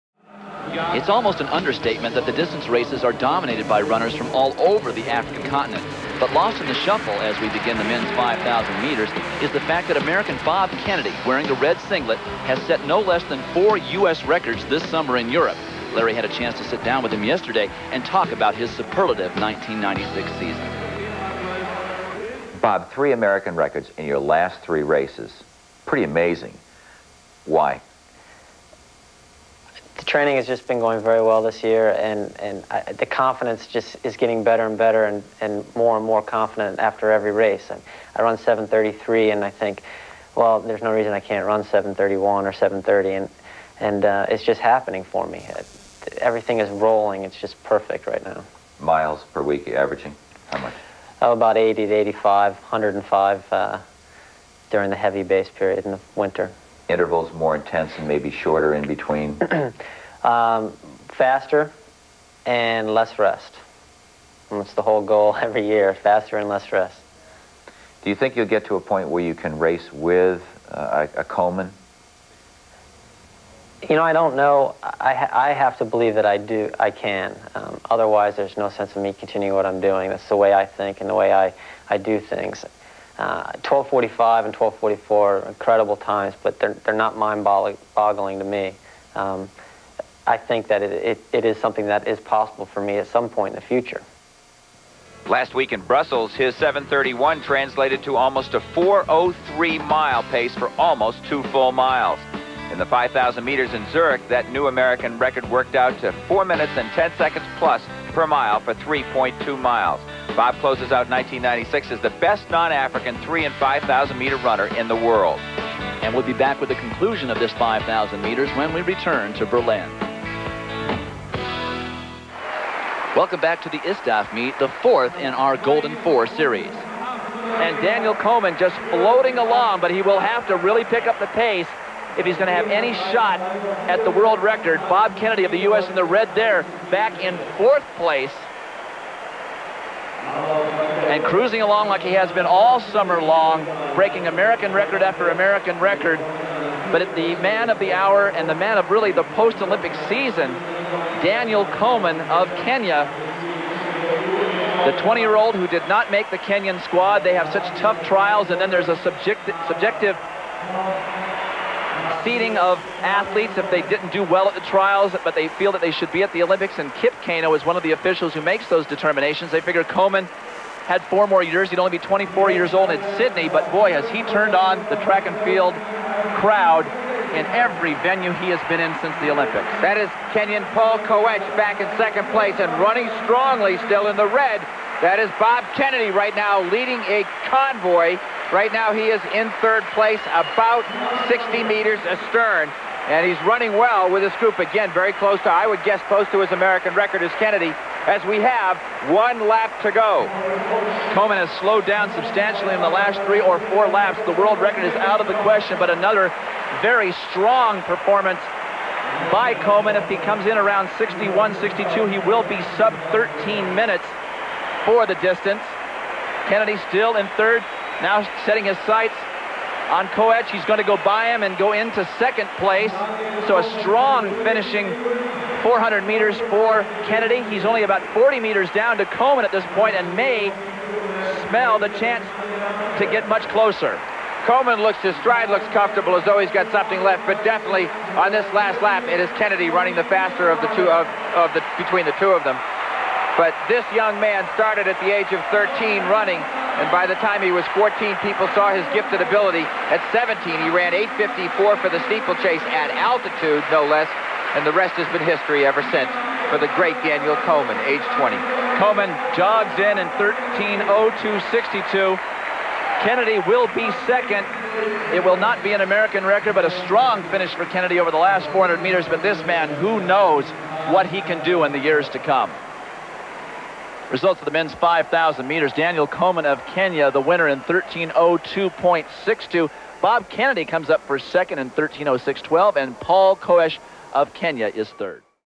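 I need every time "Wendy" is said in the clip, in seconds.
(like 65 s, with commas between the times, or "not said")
not said.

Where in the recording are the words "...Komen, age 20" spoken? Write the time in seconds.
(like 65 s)
257 s.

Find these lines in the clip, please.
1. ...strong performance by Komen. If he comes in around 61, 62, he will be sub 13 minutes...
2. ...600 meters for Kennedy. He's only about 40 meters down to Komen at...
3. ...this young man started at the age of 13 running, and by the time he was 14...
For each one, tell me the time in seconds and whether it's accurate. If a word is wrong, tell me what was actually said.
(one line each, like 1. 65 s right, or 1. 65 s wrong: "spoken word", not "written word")
1. 207 s right
2. 225 s wrong: "400", not "600"
3. 243 s right.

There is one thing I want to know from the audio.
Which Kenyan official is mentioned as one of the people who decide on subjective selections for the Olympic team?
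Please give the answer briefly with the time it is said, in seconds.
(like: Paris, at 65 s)
Kip Keino, at 166 s.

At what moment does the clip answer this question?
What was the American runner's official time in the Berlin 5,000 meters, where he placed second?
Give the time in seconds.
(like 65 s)
281 s.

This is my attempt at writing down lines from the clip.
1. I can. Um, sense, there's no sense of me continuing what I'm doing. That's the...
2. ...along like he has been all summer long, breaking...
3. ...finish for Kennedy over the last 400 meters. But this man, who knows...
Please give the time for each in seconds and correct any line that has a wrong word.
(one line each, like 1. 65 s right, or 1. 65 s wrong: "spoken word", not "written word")
1. 76 s wrong: "otherwise", not "sense"
2. 141 s right
3. 267 s right.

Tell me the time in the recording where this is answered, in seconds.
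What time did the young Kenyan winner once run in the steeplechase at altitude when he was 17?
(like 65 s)
251 s.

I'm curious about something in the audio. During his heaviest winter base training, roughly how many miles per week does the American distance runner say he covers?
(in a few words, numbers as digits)
105.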